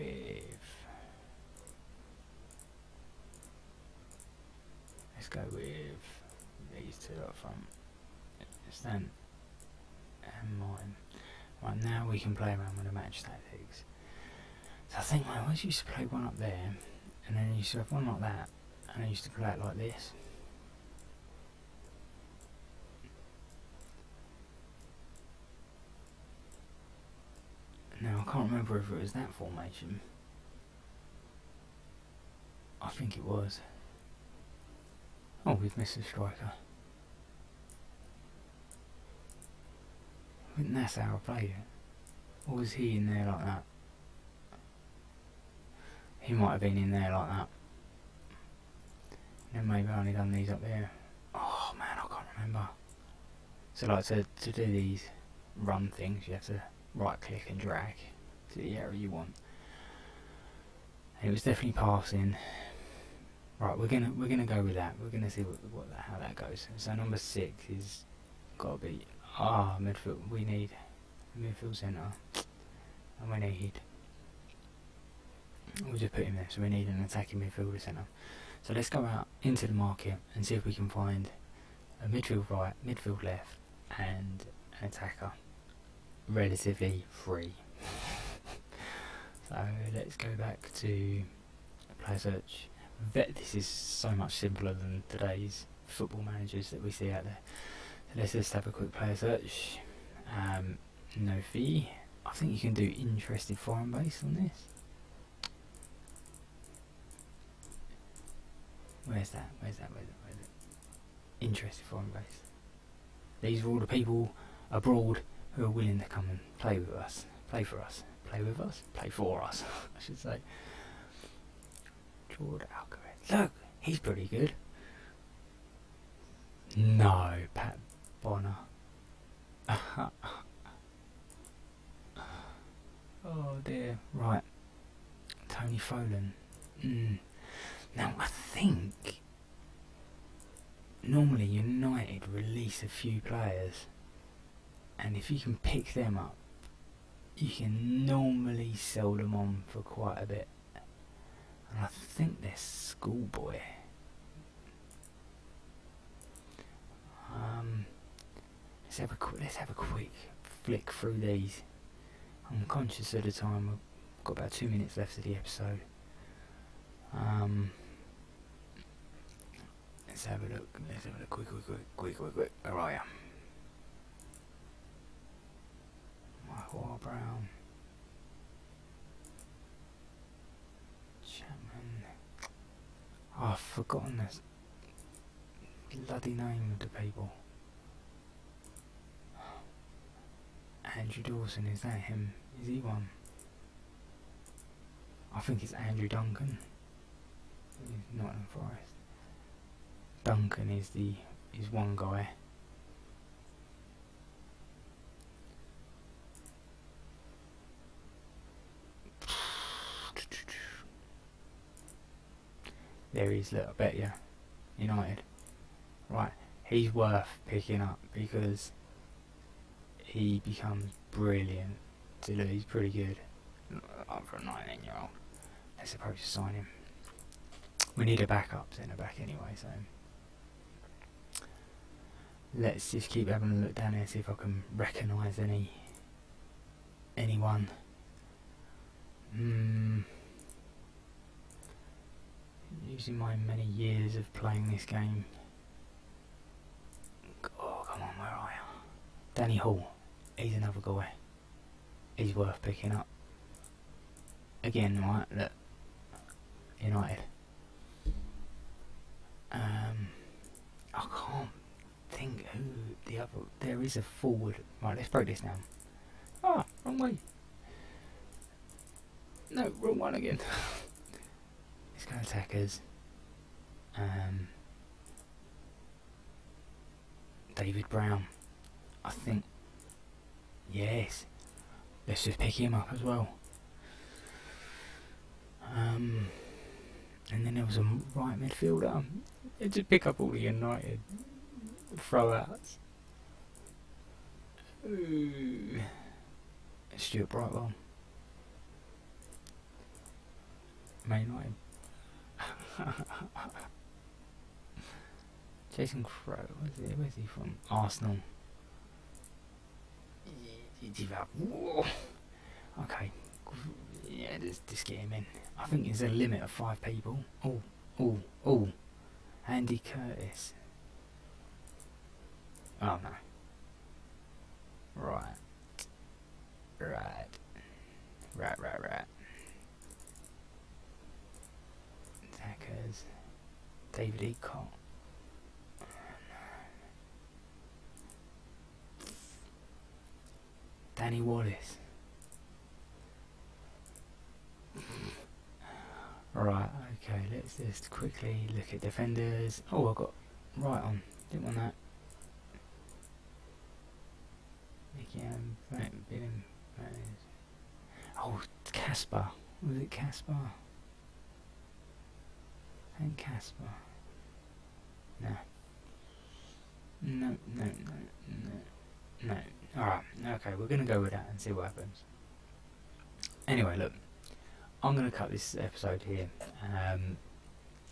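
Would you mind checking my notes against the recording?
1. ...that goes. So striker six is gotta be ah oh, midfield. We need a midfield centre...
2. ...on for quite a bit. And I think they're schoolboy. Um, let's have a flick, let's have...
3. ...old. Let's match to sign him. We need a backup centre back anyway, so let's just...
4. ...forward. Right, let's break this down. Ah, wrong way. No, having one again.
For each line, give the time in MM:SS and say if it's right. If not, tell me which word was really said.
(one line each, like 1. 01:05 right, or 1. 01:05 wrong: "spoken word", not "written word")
1. 01:06 wrong: "number", not "striker"
2. 02:29 wrong: "quick", not "flick"
3. 03:45 wrong: "approach", not "match"
4. 04:24 wrong: "wrong", not "having".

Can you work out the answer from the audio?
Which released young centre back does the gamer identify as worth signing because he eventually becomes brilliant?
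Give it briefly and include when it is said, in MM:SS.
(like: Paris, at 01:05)
Andrew Duncan, at 03:15.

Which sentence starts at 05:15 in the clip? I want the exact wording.
I think there's a limit of five people.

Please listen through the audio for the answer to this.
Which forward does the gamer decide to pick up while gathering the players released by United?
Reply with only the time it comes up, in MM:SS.
04:37.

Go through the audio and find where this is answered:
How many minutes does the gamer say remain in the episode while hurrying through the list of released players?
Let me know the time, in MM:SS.
02:44.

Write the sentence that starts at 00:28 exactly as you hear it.
remember if it was that formation.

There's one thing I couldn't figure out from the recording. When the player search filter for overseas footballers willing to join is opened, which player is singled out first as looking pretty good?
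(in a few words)
George Alcaraz.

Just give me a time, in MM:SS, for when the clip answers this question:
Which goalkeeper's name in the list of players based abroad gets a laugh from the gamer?
02:07.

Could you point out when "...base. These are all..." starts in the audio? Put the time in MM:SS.
01:52.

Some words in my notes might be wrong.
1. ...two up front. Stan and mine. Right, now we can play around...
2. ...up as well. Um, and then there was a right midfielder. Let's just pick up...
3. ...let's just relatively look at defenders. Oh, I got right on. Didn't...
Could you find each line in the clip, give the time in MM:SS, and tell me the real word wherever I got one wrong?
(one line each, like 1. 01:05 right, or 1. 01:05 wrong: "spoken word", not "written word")
1. 00:07 right
2. 04:42 right
3. 05:47 wrong: "quickly", not "relatively".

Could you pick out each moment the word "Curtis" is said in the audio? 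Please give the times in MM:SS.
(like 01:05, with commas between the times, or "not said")
05:19.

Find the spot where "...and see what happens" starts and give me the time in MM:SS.
06:11.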